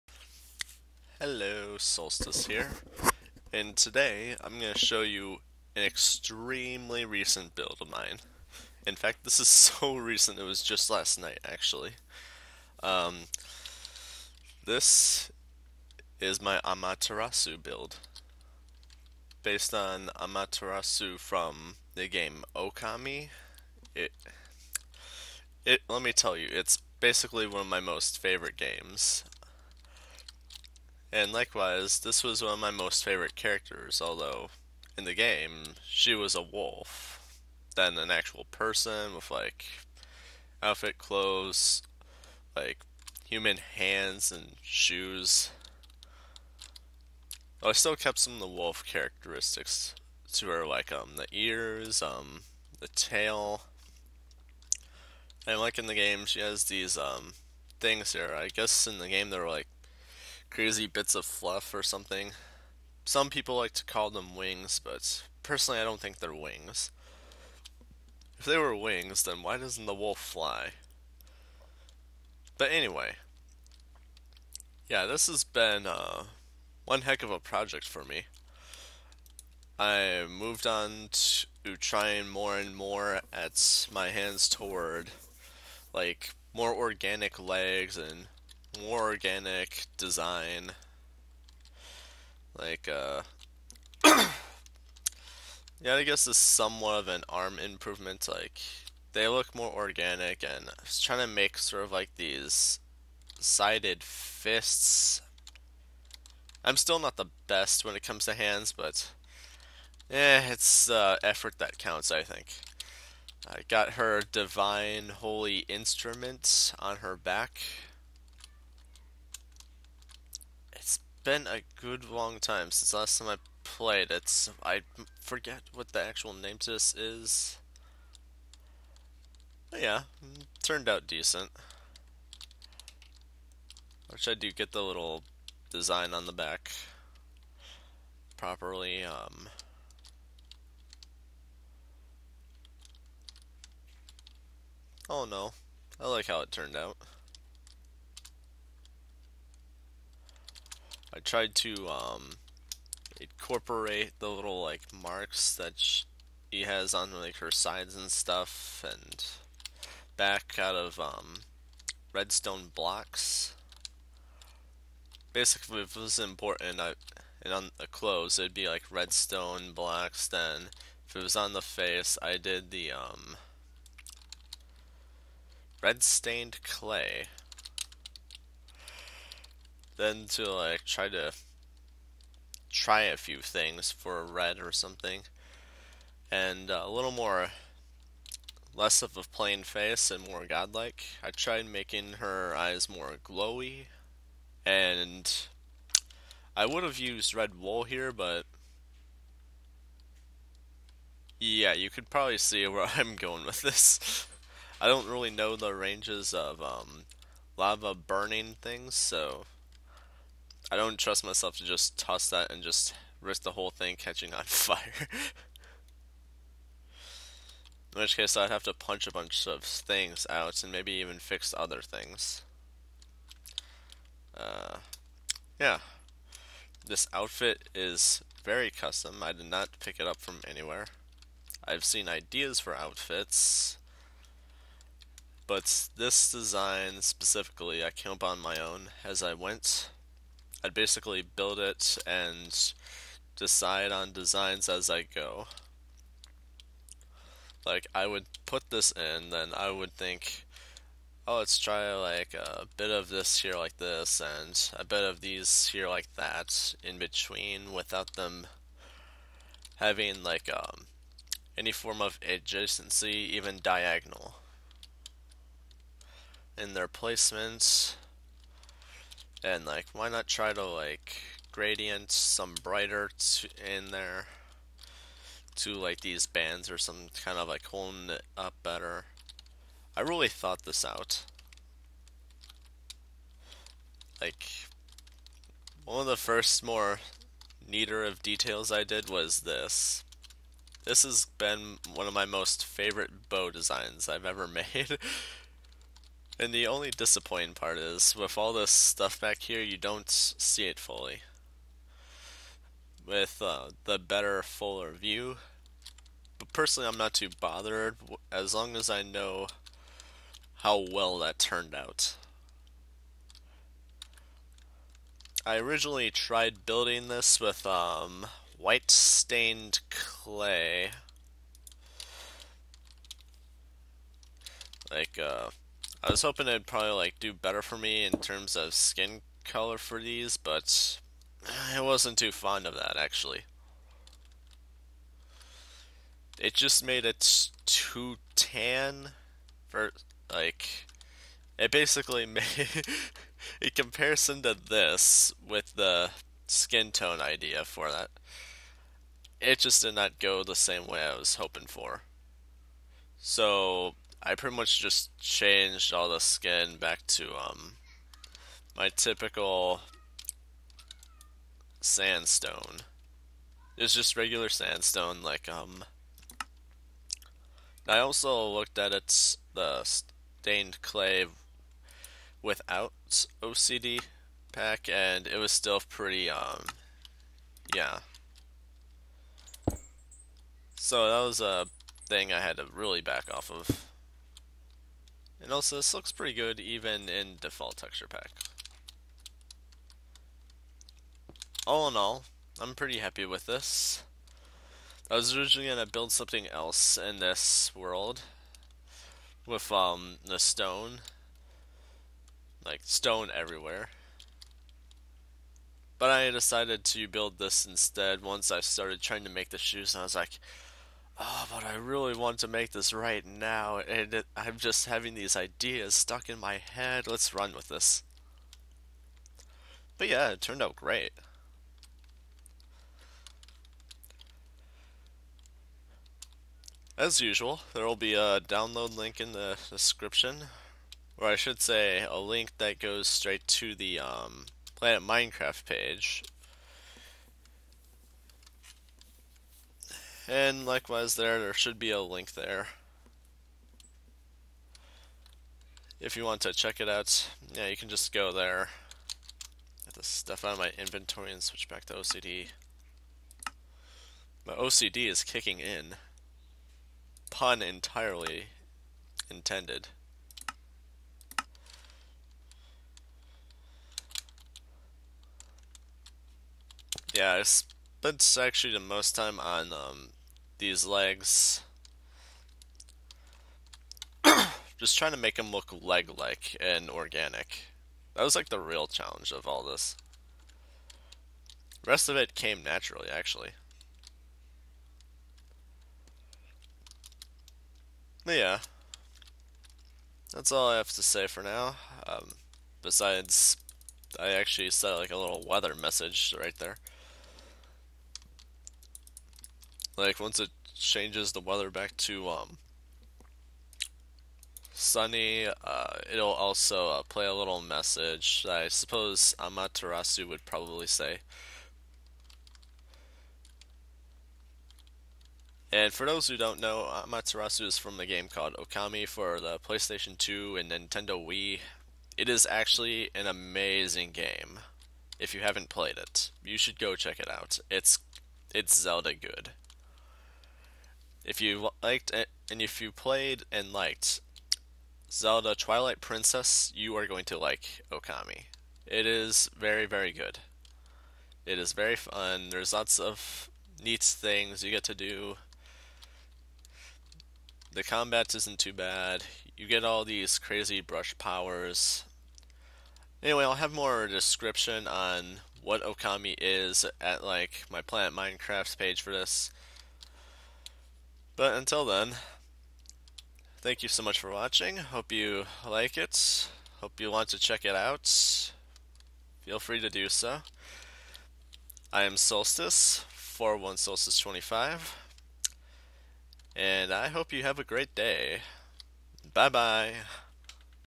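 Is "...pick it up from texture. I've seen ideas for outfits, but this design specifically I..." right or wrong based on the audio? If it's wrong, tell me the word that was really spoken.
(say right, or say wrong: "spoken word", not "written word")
wrong: "anywhere", not "texture".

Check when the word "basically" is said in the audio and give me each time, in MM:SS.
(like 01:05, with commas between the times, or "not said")
00:26, 02:45, 04:00, 05:41.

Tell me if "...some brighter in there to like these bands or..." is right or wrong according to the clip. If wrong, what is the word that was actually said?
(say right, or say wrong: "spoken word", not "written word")
right.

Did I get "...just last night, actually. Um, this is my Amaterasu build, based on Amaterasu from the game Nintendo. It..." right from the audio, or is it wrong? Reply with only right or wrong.
wrong.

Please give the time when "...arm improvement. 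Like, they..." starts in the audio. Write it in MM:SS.
01:37.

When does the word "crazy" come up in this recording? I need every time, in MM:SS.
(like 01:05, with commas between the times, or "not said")
01:00, 09:10.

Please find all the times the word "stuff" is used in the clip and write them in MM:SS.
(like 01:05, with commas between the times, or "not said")
02:38, 04:58, 07:30.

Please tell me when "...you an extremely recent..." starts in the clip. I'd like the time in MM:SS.
00:05.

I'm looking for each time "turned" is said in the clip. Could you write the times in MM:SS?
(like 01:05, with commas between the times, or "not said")
02:10, 02:26, 05:11, 07:00.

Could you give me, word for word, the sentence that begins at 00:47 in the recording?
Well, oh, I still kept some of the wolf characteristics to her, like um the ears, um the tail.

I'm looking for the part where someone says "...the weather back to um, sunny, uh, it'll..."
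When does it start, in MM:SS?
08:21.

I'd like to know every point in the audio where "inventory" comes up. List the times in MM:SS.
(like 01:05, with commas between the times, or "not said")
07:30.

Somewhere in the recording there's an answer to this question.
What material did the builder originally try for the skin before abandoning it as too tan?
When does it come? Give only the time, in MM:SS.
05:18.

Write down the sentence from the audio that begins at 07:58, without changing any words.
That was like the real challenge of all this.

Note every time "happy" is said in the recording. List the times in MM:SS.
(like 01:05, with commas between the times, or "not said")
06:32.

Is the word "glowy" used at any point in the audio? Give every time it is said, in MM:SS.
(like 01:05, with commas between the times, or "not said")
03:13.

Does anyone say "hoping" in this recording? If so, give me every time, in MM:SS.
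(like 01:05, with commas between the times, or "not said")
05:26, 05:51.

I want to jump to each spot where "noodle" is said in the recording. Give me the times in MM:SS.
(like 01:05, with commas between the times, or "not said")
not said.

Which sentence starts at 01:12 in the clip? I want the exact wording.
But anyway, yeah, this has been uh, one heck of a project for me.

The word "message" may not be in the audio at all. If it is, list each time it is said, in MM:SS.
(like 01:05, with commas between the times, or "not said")
08:15, 08:27.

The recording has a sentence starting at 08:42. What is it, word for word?
It is actually an amazing game.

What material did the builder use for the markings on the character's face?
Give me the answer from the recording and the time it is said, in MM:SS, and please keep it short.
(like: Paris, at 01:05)
Red stained clay, at 02:55.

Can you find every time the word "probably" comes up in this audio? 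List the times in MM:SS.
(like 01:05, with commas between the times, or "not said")
03:22, 05:26, 08:30.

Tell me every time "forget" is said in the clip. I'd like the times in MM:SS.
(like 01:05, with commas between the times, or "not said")
02:05.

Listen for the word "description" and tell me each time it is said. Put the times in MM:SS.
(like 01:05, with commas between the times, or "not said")
07:09, 09:14.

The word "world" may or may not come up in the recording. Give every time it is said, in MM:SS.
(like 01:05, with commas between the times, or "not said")
06:37.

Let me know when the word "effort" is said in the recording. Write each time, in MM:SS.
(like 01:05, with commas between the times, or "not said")
01:51.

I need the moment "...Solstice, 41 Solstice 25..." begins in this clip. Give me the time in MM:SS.
09:32.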